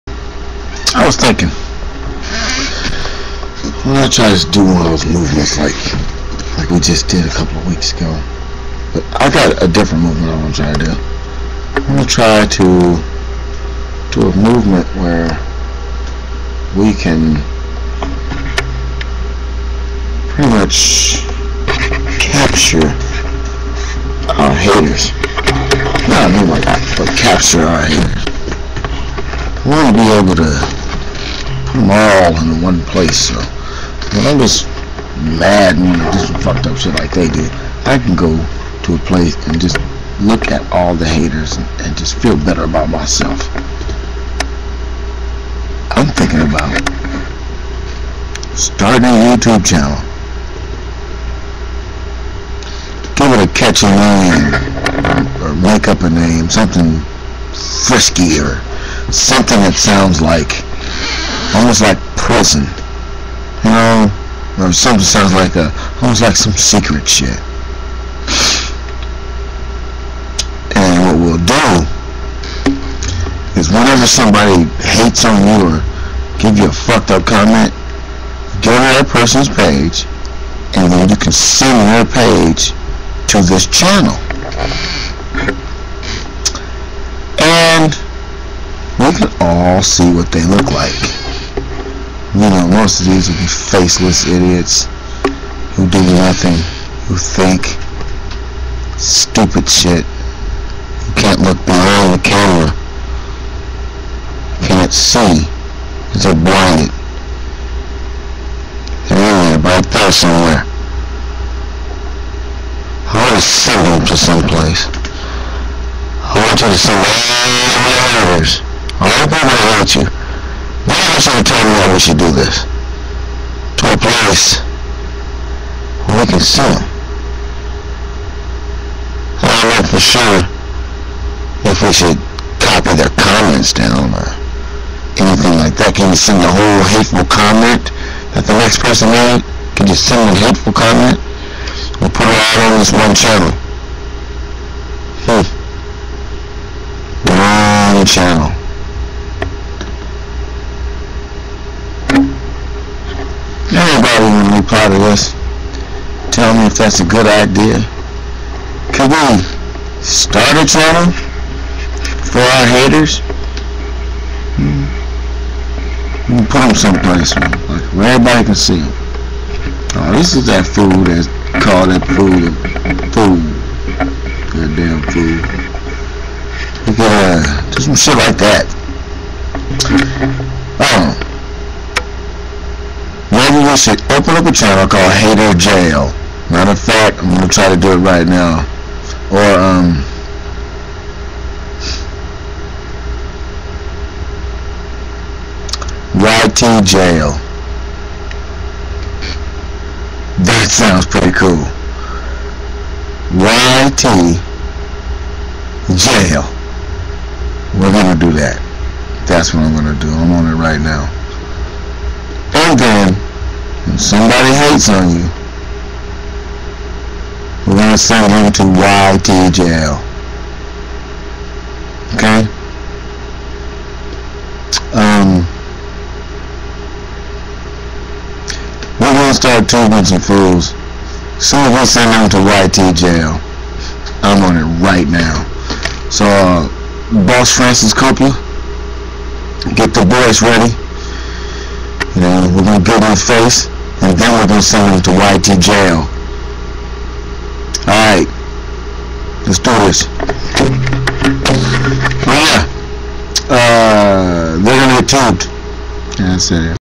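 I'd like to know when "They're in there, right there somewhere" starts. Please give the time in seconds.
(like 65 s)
109 s.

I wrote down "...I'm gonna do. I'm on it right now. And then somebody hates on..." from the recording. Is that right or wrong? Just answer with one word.
right.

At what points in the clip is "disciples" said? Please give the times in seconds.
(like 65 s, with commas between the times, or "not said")
not said.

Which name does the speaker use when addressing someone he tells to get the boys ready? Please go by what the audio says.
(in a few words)
Francis Coppola.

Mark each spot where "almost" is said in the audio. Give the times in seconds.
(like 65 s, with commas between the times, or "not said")
61 s, 66 s.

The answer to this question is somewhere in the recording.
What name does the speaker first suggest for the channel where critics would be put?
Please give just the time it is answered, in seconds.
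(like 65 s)
185 s.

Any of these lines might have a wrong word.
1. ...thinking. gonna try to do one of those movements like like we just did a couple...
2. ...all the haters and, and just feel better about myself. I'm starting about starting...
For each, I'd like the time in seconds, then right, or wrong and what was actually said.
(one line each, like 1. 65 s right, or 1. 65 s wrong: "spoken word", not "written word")
1. 1 s right
2. 40 s wrong: "thinking", not "starting".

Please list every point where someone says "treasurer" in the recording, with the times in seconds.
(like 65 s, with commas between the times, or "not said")
not said.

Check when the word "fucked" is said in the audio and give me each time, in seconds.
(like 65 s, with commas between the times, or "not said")
36 s, 76 s.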